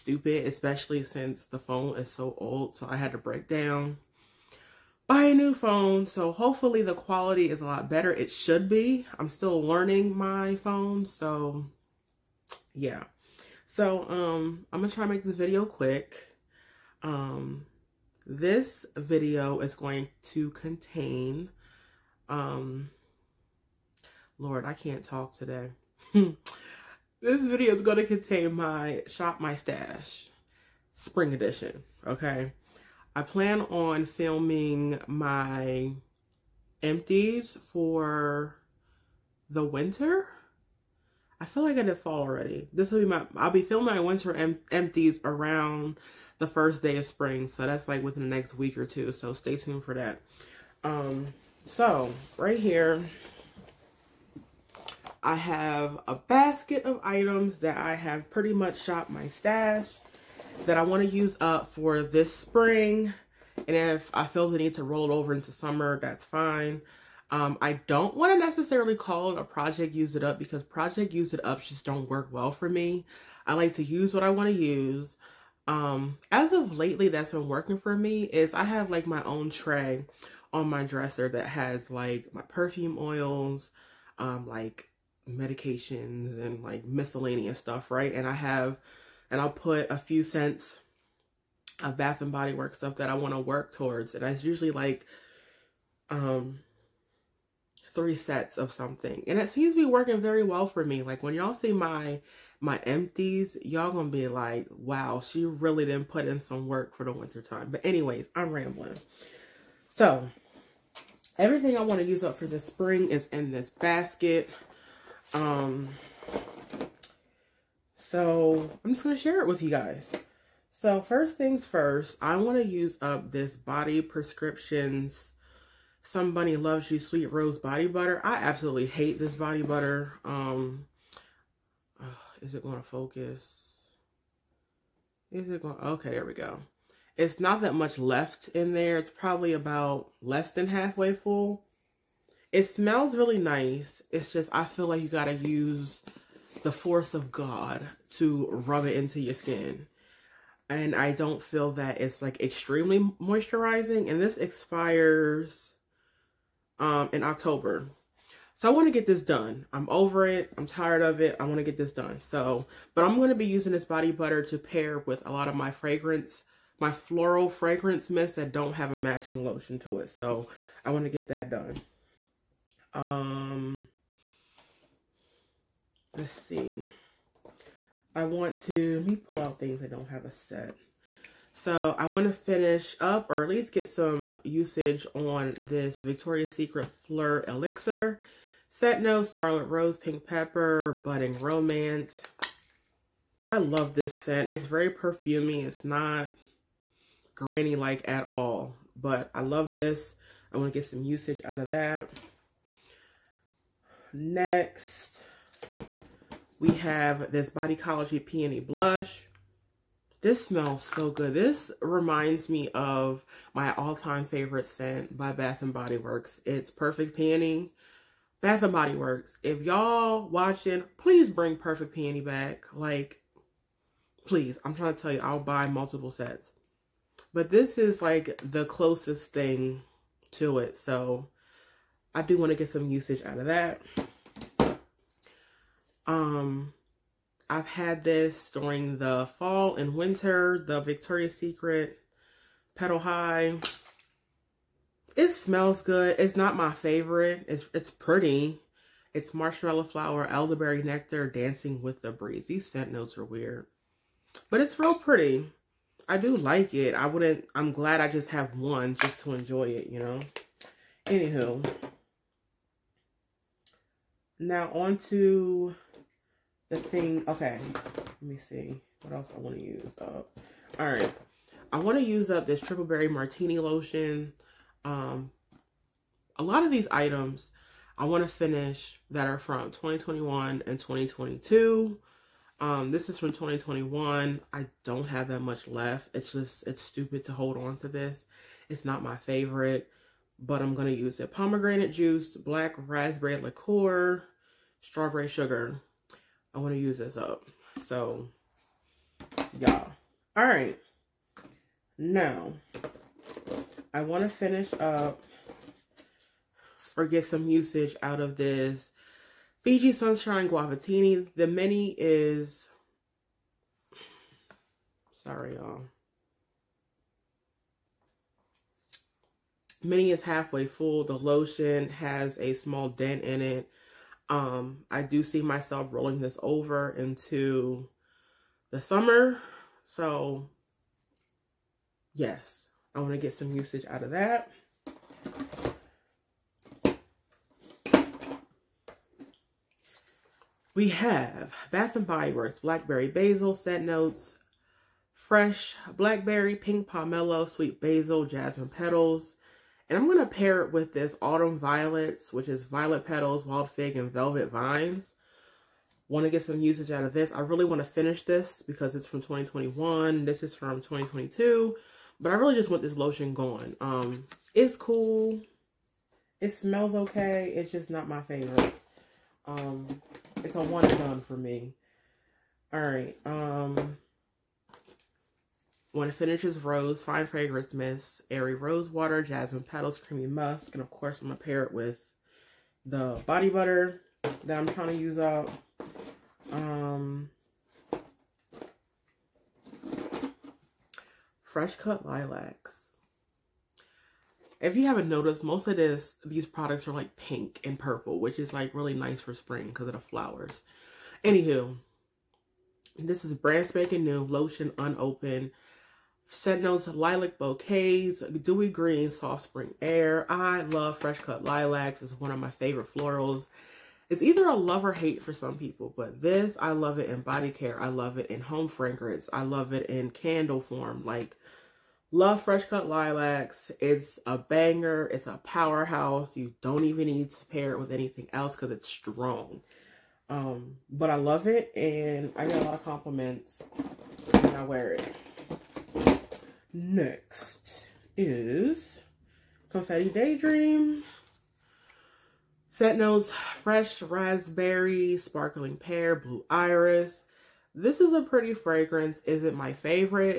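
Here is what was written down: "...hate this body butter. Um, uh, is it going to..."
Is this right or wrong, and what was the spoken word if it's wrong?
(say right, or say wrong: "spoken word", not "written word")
right.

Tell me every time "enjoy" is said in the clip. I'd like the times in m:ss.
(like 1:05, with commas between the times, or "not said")
4:19.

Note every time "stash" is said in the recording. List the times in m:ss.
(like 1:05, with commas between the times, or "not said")
0:29, 0:59.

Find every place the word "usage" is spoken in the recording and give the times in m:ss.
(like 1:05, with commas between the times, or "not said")
3:04, 3:21, 3:52, 5:07, 5:33, 5:56.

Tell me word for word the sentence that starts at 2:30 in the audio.
And I don't feel that it's like extremely moisturizing.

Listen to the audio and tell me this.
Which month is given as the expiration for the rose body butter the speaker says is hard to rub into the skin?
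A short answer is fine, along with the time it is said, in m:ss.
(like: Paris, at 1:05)
October, at 2:37.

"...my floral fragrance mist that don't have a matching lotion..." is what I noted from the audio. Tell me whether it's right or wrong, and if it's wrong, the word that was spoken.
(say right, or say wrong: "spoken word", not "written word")
right.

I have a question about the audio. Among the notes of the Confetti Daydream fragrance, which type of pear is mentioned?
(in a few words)
sparkling pear.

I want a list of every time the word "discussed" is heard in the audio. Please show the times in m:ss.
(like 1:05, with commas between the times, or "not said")
not said.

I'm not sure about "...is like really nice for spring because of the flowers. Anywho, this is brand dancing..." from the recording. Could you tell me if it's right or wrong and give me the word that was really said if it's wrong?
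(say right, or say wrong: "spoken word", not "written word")
wrong: "spanking", not "dancing".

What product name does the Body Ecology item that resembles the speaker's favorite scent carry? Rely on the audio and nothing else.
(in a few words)
Peony Blush.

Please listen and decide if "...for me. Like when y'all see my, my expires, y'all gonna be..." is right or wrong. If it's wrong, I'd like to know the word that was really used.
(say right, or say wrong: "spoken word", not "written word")
wrong: "empties", not "expires".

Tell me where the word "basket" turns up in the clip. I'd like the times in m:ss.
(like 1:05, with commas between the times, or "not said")
0:56, 1:53.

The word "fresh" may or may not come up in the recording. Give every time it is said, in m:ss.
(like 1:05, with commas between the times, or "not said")
5:45, 6:31, 6:50, 7:02, 7:23.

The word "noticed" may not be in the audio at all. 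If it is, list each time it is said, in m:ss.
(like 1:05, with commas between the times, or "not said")
6:35.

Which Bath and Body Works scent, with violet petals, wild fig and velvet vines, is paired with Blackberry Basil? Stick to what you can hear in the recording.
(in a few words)
Autumn Violets.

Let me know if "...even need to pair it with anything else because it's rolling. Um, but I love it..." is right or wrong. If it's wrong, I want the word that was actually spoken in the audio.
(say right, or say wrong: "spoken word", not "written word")
wrong: "strong", not "rolling".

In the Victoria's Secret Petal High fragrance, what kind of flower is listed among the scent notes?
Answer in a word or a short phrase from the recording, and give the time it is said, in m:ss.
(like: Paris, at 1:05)
marshmallow flower, at 4:09.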